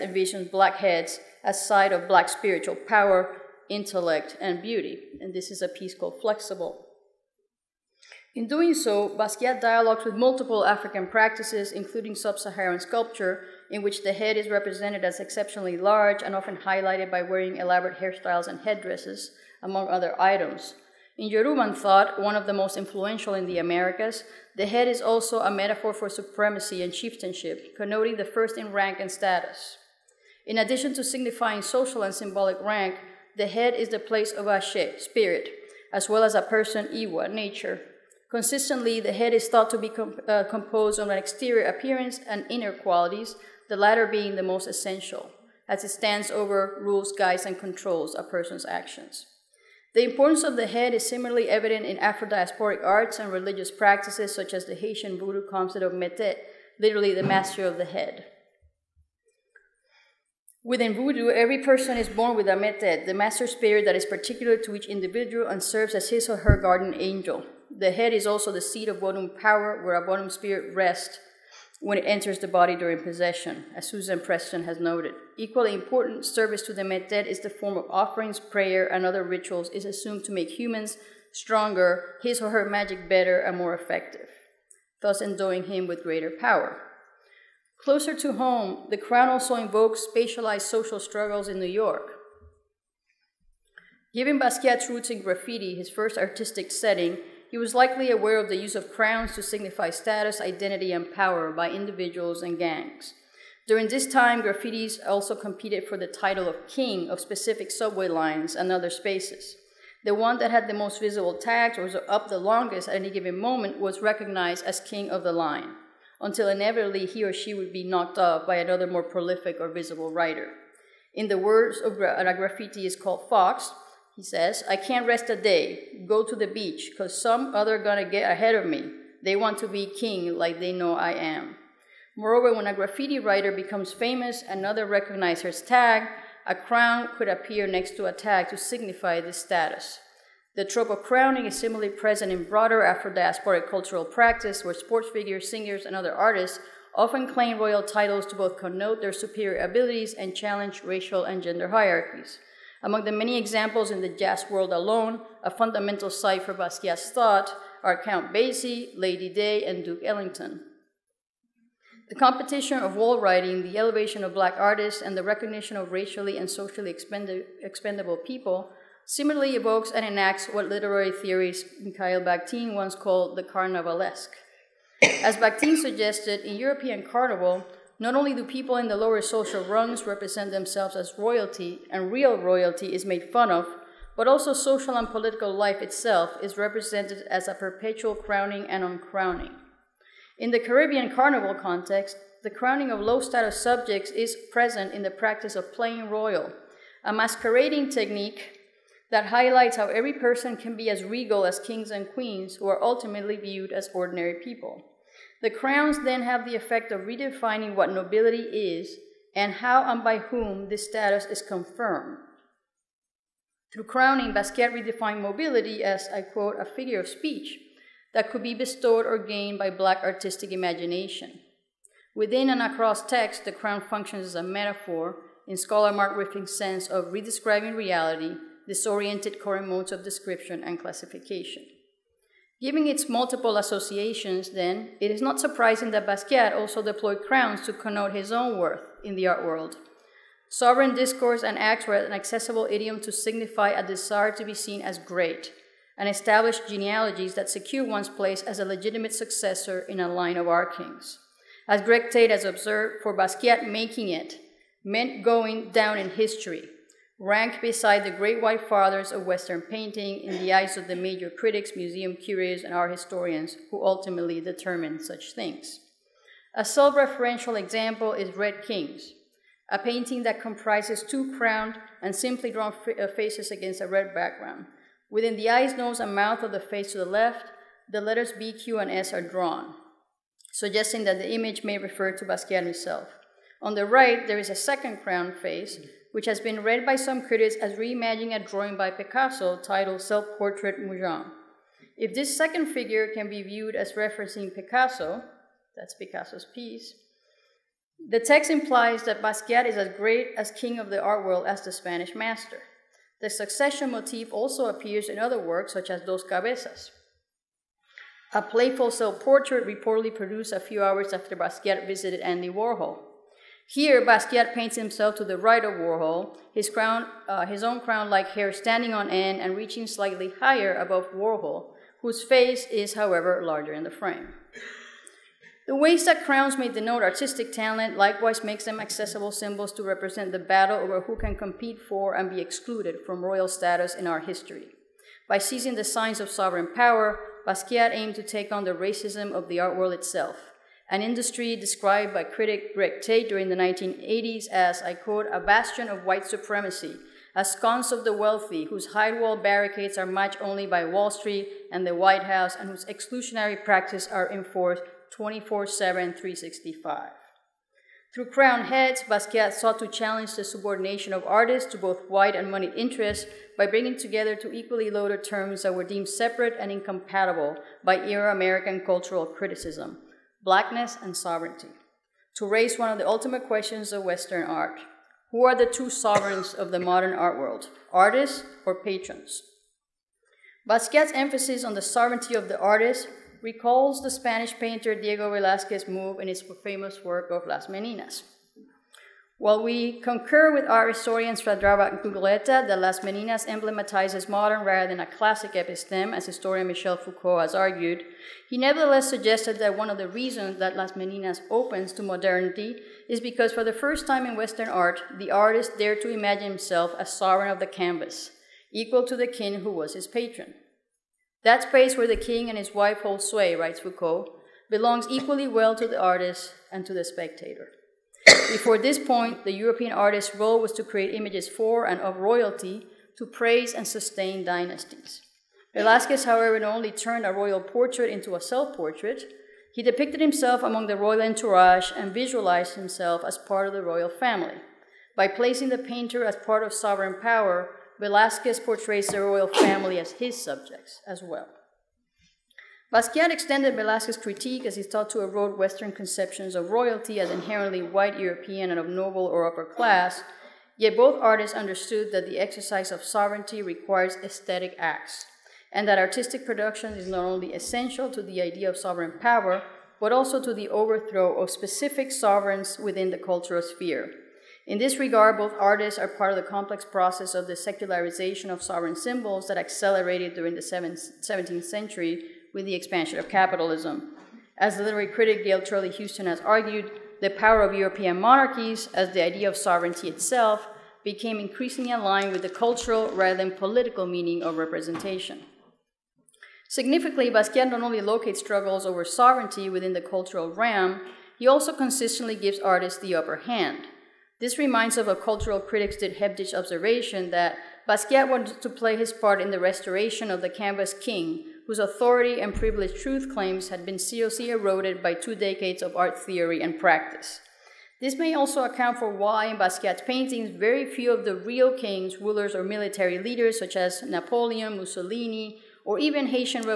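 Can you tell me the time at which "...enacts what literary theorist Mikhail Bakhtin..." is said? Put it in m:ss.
2:50.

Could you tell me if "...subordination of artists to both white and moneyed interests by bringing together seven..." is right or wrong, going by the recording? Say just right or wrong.
wrong.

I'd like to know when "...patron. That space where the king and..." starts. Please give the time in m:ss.
6:50.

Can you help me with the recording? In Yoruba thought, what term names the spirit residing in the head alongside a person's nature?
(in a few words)
Ashe.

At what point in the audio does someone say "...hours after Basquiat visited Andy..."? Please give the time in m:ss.
5:10.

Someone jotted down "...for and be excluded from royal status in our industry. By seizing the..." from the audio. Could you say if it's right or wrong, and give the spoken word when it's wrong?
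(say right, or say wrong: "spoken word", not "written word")
wrong: "history", not "industry".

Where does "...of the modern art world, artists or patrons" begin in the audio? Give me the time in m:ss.
6:16.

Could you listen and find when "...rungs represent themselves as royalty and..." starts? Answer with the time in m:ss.
2:59.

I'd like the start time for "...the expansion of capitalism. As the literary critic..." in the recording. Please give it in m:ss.
7:52.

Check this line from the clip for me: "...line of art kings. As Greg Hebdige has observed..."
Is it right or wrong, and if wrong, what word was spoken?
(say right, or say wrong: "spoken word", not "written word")
wrong: "Tate", not "Hebdige".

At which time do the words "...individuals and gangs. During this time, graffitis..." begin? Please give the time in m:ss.
1:41.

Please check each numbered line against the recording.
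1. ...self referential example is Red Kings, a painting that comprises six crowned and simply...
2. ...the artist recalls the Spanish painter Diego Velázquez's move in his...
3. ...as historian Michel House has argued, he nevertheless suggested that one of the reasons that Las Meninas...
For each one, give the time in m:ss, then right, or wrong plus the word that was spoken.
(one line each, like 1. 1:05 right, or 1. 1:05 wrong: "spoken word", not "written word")
1. 4:26 wrong: "two", not "six"
2. 6:22 right
3. 6:36 wrong: "Foucault", not "House".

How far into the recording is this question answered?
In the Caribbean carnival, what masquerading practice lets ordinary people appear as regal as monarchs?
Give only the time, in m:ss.
3:15.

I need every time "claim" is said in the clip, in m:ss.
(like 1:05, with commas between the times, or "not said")
2:27, 8:23.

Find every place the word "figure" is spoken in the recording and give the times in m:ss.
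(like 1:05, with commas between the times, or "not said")
2:25, 3:36, 4:52.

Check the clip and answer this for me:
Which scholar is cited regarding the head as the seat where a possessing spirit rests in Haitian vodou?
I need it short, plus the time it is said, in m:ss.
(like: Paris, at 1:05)
Susan Preston, at 1:13.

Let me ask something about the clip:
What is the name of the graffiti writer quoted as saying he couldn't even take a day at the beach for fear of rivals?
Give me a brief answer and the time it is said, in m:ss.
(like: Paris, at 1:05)
Fox, at 2:03.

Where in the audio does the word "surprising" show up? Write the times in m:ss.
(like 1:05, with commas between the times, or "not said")
3:55.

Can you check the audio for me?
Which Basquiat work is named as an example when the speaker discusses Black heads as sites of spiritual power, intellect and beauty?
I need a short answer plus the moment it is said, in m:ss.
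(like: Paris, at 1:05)
Flexible, at 0:06.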